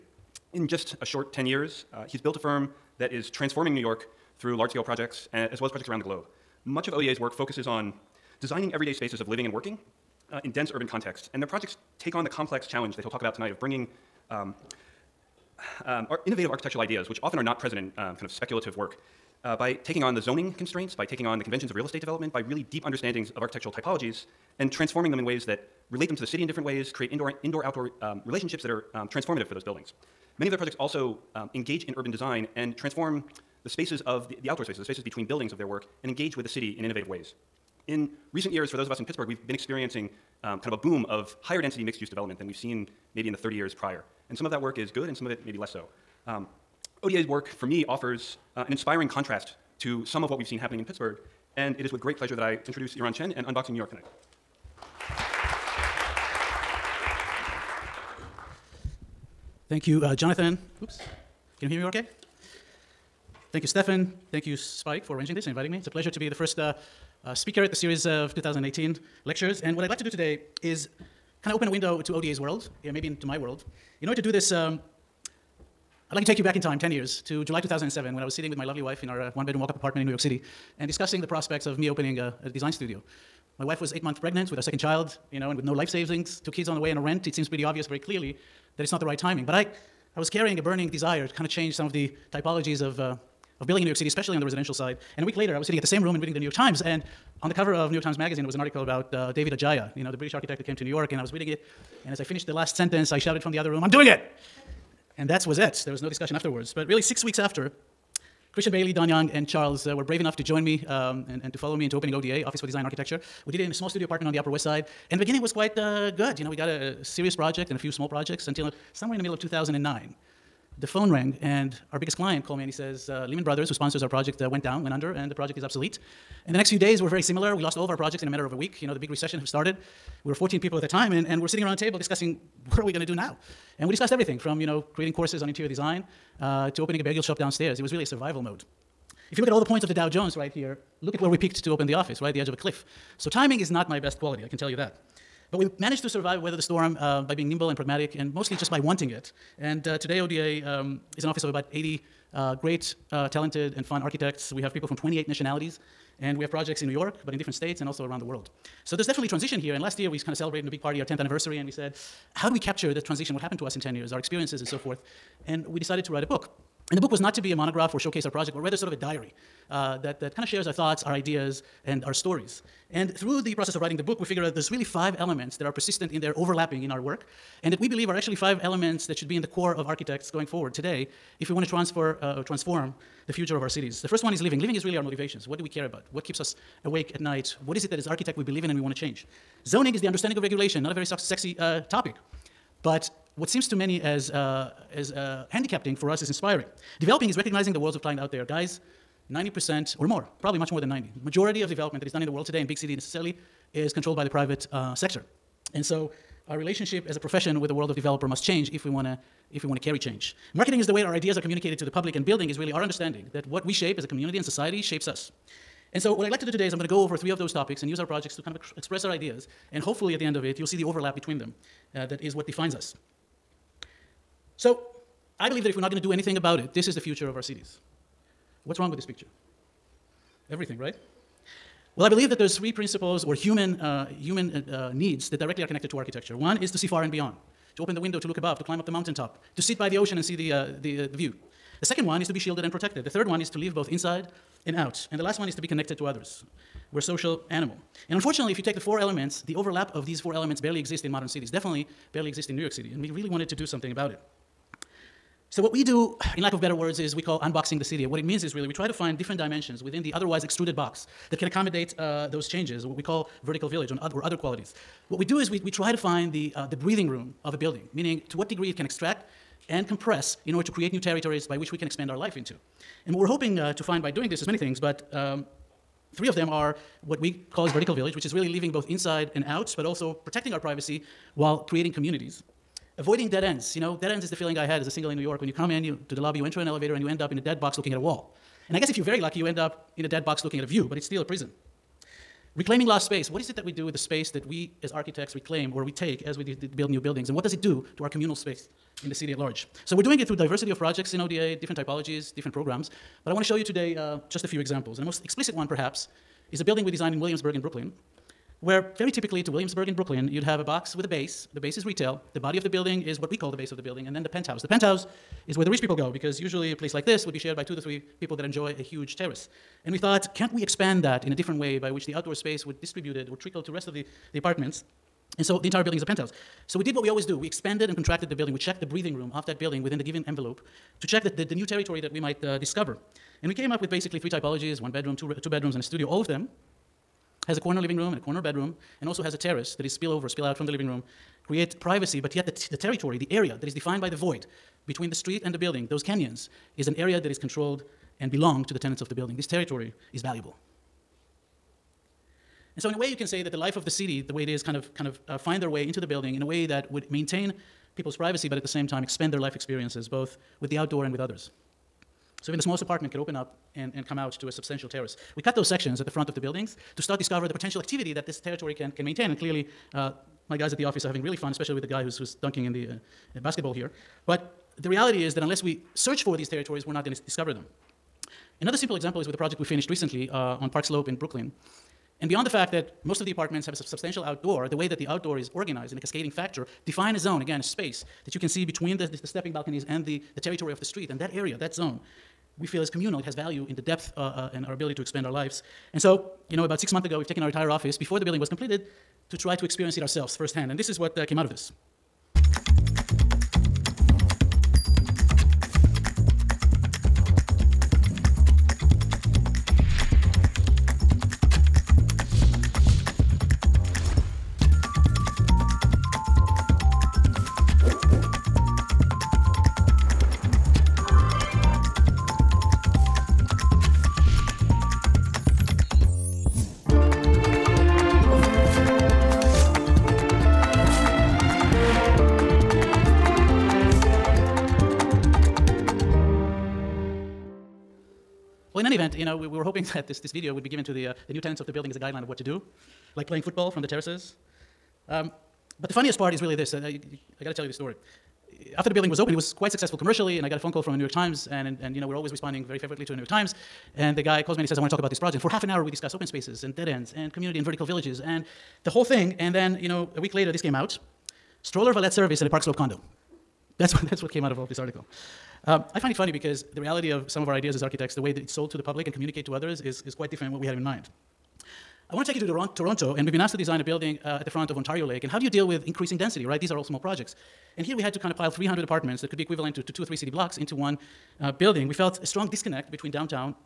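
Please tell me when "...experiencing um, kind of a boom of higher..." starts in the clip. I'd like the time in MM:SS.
00:39.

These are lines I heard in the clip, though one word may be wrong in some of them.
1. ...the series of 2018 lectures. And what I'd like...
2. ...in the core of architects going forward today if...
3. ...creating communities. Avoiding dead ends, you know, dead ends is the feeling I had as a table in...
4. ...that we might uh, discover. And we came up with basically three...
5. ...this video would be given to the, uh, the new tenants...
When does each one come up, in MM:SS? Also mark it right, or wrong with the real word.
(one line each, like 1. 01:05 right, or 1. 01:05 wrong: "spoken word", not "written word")
1. 01:07 right
2. 02:59 right
3. 04:41 wrong: "single", not "table"
4. 05:32 right
5. 07:20 right.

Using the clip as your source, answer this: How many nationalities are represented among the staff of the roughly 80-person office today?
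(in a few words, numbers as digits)
28.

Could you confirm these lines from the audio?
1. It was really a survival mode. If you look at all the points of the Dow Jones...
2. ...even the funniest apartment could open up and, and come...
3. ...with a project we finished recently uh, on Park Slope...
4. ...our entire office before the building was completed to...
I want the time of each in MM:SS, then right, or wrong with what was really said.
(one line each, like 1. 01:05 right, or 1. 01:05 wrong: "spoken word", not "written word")
1. 02:17 right
2. 06:02 wrong: "smallest", not "funniest"
3. 06:19 right
4. 06:37 right.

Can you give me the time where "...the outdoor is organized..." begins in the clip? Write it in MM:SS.
06:24.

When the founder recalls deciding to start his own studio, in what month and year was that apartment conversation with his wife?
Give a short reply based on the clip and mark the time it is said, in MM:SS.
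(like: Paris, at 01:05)
July 2007, at 01:17.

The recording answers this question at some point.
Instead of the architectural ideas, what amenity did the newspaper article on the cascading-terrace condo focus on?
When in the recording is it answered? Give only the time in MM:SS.
07:41.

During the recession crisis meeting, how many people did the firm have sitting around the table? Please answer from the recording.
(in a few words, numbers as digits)
14.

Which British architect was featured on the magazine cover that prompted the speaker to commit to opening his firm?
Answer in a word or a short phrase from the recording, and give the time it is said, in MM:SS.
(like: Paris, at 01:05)
David Adjaye, at 01:39.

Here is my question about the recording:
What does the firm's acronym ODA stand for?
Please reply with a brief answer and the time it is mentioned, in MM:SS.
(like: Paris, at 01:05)
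Office for Design and Architecture, at 01:52.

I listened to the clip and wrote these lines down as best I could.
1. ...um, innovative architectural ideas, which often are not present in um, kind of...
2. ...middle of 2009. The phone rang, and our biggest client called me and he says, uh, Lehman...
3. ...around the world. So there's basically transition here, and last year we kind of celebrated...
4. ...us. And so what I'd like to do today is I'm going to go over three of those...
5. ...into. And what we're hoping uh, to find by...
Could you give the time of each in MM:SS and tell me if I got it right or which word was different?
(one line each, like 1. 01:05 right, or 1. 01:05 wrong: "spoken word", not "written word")
1. 00:15 right
2. 01:59 right
3. 02:38 wrong: "definitely", not "basically"
4. 03:35 right
5. 04:32 right.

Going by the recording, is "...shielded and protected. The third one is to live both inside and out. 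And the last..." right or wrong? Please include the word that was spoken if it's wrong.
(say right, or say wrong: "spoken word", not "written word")
right.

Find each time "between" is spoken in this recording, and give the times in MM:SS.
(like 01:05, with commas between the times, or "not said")
00:35, 03:41, 05:44, 06:28, 08:02.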